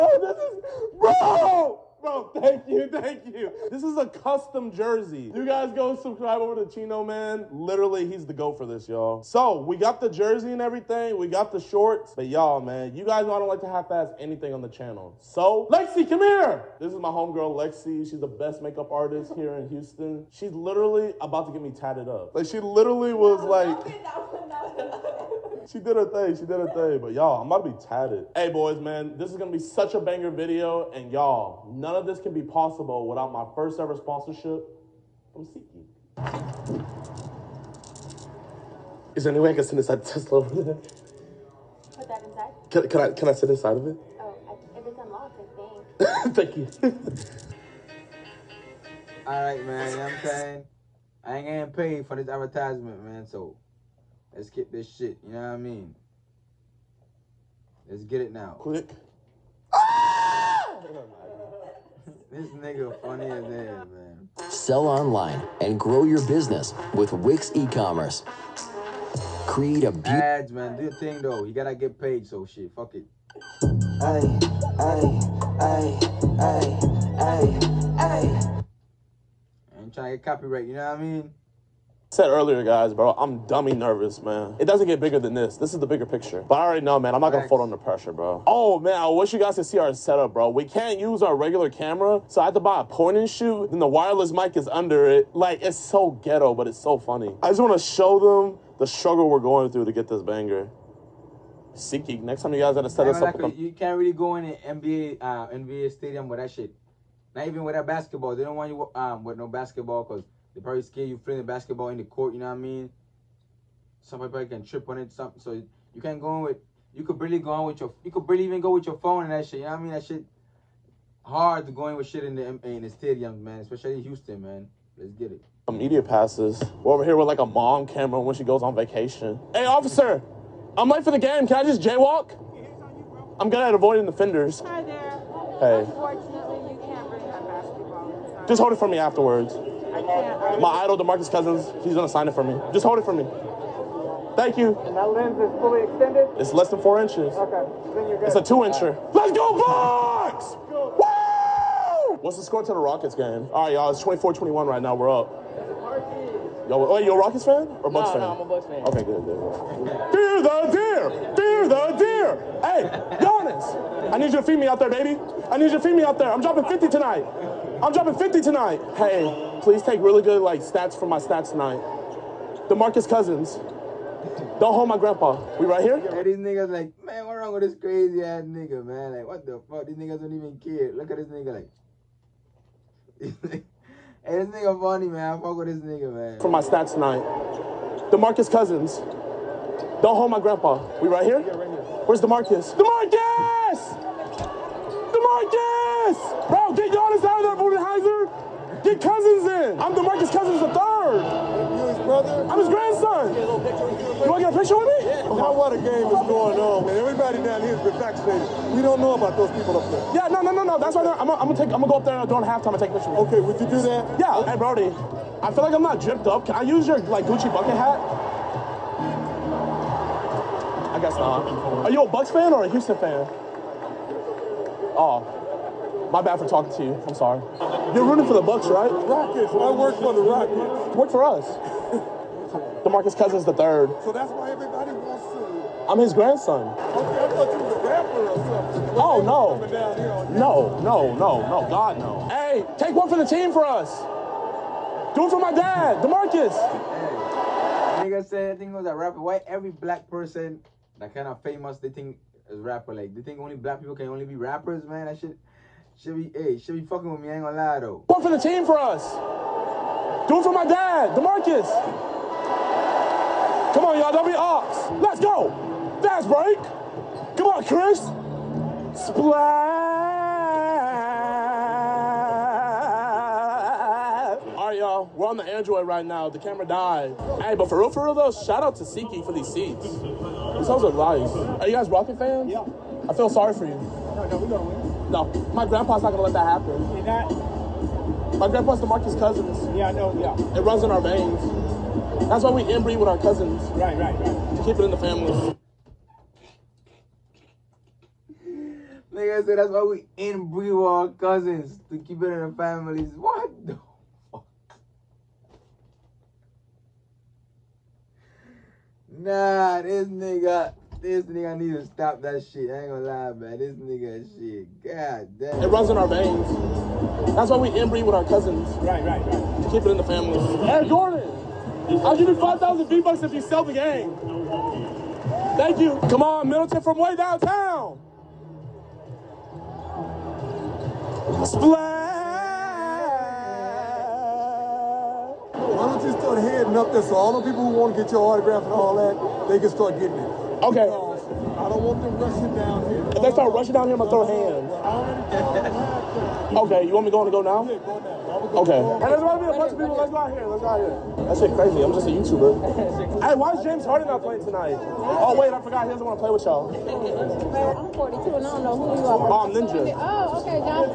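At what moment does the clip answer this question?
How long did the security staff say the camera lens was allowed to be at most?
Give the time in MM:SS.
02:26.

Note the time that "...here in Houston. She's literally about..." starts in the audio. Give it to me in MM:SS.
00:19.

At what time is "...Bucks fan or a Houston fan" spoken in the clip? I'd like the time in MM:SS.
03:42.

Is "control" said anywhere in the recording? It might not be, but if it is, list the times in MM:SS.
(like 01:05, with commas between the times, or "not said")
not said.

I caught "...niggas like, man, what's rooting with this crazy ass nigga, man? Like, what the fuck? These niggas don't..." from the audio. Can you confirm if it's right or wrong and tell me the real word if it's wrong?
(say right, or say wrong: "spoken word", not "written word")
wrong: "wrong", not "rooting".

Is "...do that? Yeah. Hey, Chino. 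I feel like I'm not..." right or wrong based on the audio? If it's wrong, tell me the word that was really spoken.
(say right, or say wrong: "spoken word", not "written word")
wrong: "Brody", not "Chino".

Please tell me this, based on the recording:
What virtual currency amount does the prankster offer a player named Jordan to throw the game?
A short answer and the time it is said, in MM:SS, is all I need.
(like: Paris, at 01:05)
5,000 V-Bucks, at 05:22.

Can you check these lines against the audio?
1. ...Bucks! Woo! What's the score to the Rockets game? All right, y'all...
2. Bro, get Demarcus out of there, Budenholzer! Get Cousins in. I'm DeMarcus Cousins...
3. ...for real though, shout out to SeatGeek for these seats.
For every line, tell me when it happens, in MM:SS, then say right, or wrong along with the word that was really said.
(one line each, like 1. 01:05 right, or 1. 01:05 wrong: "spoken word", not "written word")
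1. 02:29 right
2. 03:16 wrong: "Giannis", not "Demarcus"
3. 04:37 right.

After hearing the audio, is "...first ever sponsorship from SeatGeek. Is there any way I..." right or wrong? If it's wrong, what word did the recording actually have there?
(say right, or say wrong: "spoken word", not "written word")
right.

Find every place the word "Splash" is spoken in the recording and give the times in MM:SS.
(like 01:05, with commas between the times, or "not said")
04:29, 05:31.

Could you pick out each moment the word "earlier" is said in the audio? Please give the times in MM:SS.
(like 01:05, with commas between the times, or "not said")
01:22.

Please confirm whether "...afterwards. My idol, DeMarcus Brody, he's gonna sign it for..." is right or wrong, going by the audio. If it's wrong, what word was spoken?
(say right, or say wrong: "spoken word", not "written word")
wrong: "Cousins", not "Brody".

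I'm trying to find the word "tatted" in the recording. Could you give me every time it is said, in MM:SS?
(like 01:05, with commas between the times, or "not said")
00:21, 00:27.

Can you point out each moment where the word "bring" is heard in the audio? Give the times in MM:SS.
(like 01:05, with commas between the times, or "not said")
02:17.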